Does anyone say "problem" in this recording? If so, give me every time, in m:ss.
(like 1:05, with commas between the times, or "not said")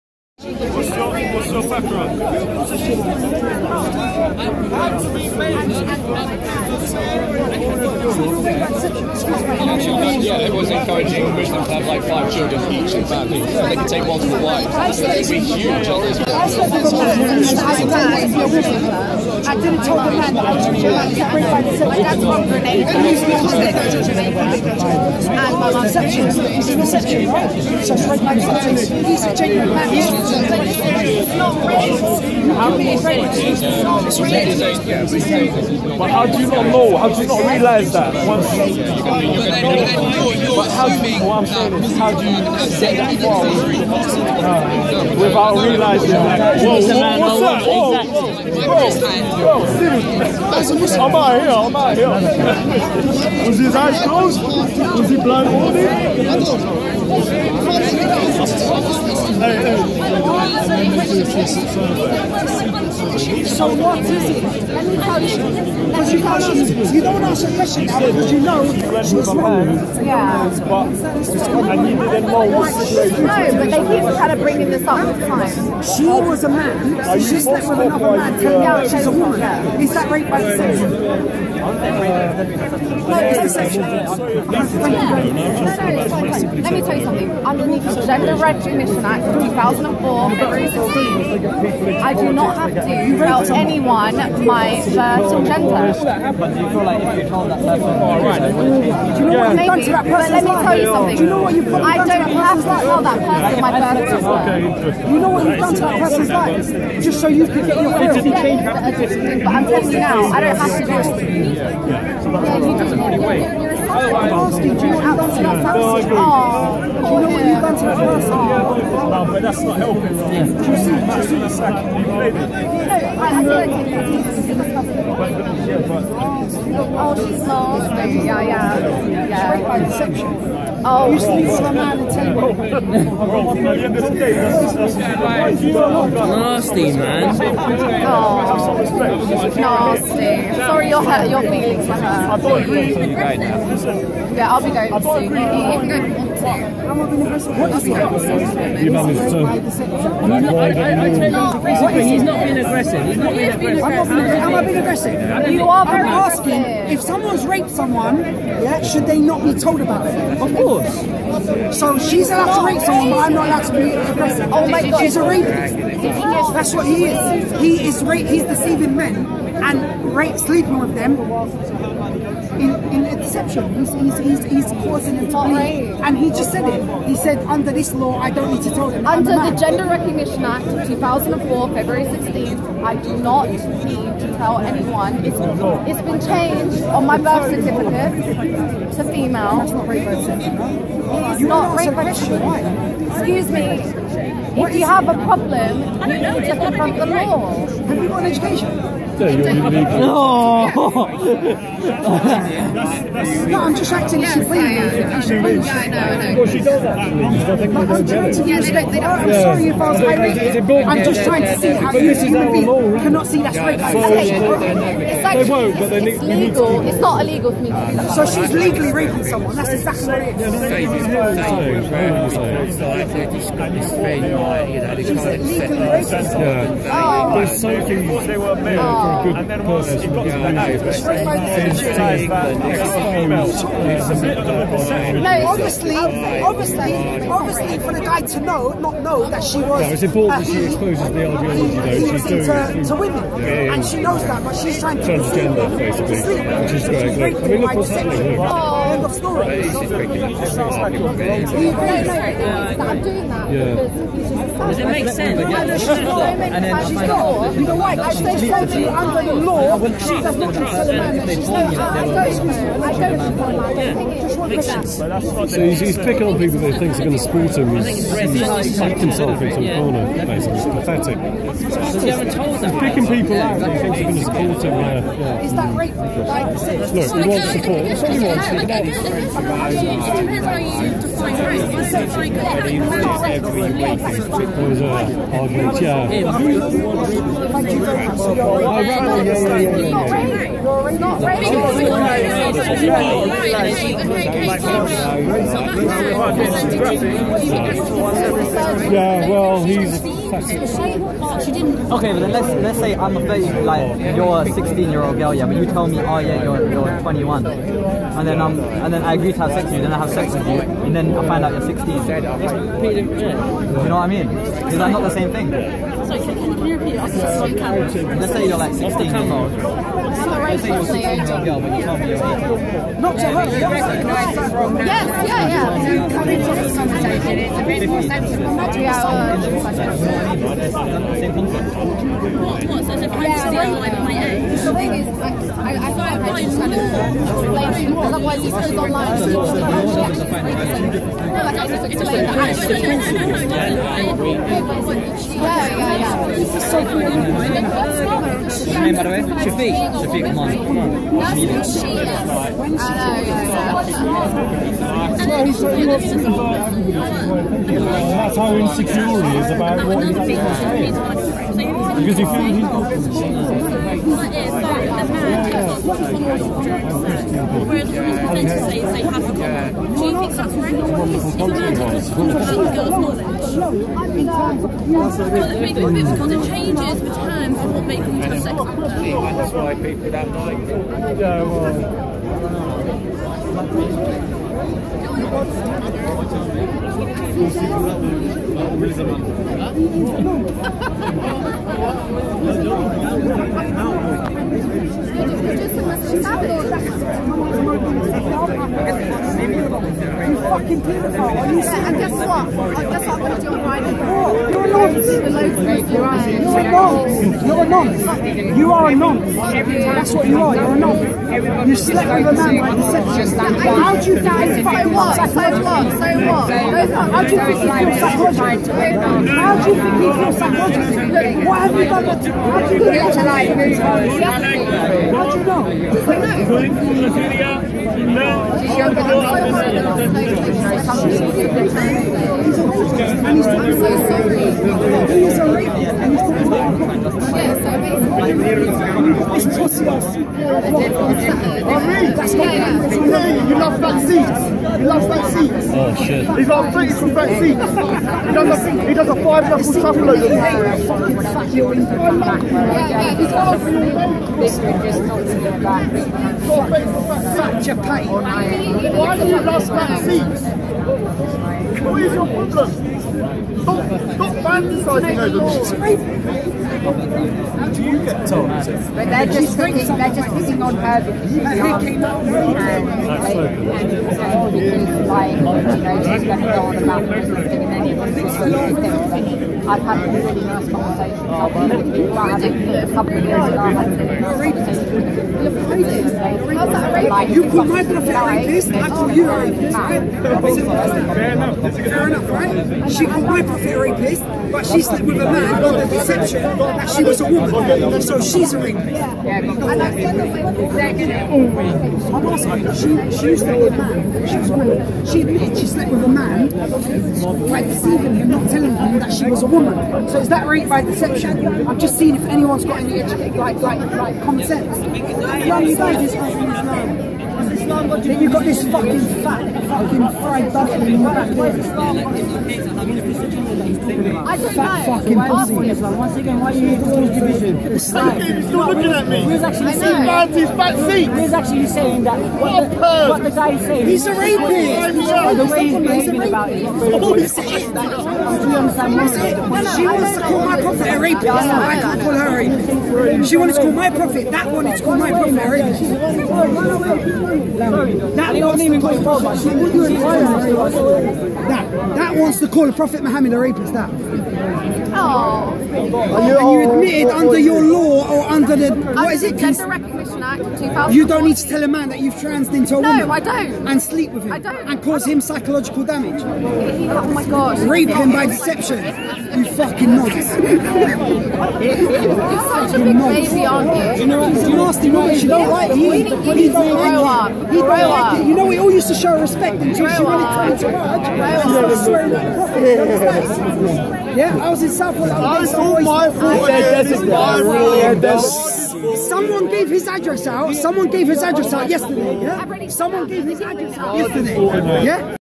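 3:15, 7:42.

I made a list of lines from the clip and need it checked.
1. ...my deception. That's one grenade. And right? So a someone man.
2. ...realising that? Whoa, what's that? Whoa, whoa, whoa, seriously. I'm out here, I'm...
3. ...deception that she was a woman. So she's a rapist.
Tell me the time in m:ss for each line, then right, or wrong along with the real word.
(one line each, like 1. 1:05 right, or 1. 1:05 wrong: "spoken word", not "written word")
1. 0:21 wrong: "genuine", not "someone"
2. 0:45 right
3. 8:15 right.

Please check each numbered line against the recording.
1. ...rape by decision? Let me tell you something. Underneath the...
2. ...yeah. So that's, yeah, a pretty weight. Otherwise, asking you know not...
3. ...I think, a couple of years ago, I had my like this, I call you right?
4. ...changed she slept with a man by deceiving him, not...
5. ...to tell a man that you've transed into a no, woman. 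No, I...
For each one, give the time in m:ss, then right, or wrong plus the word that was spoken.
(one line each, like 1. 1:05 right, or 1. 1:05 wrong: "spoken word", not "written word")
1. 1:20 right
2. 1:51 right
3. 8:02 right
4. 8:25 wrong: "admitted", not "changed"
5. 9:21 right.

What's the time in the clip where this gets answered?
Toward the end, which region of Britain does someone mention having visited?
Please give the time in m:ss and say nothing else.
9:44.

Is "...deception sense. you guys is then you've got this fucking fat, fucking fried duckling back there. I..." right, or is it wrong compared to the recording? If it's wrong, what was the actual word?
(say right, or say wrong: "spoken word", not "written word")
wrong: "common", not "deception".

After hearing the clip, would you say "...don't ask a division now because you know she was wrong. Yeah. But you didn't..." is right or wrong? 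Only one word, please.
wrong.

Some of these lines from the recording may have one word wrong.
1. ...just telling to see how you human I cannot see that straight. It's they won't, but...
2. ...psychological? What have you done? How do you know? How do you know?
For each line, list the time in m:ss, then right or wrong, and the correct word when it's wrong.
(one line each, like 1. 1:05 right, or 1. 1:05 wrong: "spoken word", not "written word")
1. 3:31 wrong: "trying", not "telling"
2. 7:00 right.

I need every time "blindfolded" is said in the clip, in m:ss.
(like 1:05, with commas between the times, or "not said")
0:55.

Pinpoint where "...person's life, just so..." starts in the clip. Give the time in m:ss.
1:45.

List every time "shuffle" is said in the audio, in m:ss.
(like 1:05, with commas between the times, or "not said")
7:29.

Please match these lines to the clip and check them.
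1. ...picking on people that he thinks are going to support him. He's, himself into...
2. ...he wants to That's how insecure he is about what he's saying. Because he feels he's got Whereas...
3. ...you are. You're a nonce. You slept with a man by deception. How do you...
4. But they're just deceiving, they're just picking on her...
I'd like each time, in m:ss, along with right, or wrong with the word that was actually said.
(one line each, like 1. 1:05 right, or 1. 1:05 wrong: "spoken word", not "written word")
1. 4:25 right
2. 5:55 right
3. 6:50 right
4. 7:48 wrong: "picking", not "deceiving".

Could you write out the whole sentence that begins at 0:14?
That's going to be huge on this one.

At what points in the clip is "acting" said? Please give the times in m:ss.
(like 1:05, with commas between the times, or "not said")
3:23.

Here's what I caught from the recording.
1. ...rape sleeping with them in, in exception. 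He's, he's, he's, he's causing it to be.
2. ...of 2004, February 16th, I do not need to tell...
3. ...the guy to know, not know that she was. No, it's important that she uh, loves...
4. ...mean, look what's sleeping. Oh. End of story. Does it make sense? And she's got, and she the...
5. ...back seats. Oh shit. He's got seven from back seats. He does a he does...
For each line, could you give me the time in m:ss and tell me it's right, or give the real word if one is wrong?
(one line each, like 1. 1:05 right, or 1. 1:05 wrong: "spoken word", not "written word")
1. 2:50 right
2. 3:00 right
3. 3:57 wrong: "exposes", not "loves"
4. 4:07 wrong: "happening", not "sleeping"
5. 7:25 wrong: "three", not "seven".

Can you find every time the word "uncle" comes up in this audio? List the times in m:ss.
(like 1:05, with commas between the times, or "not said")
not said.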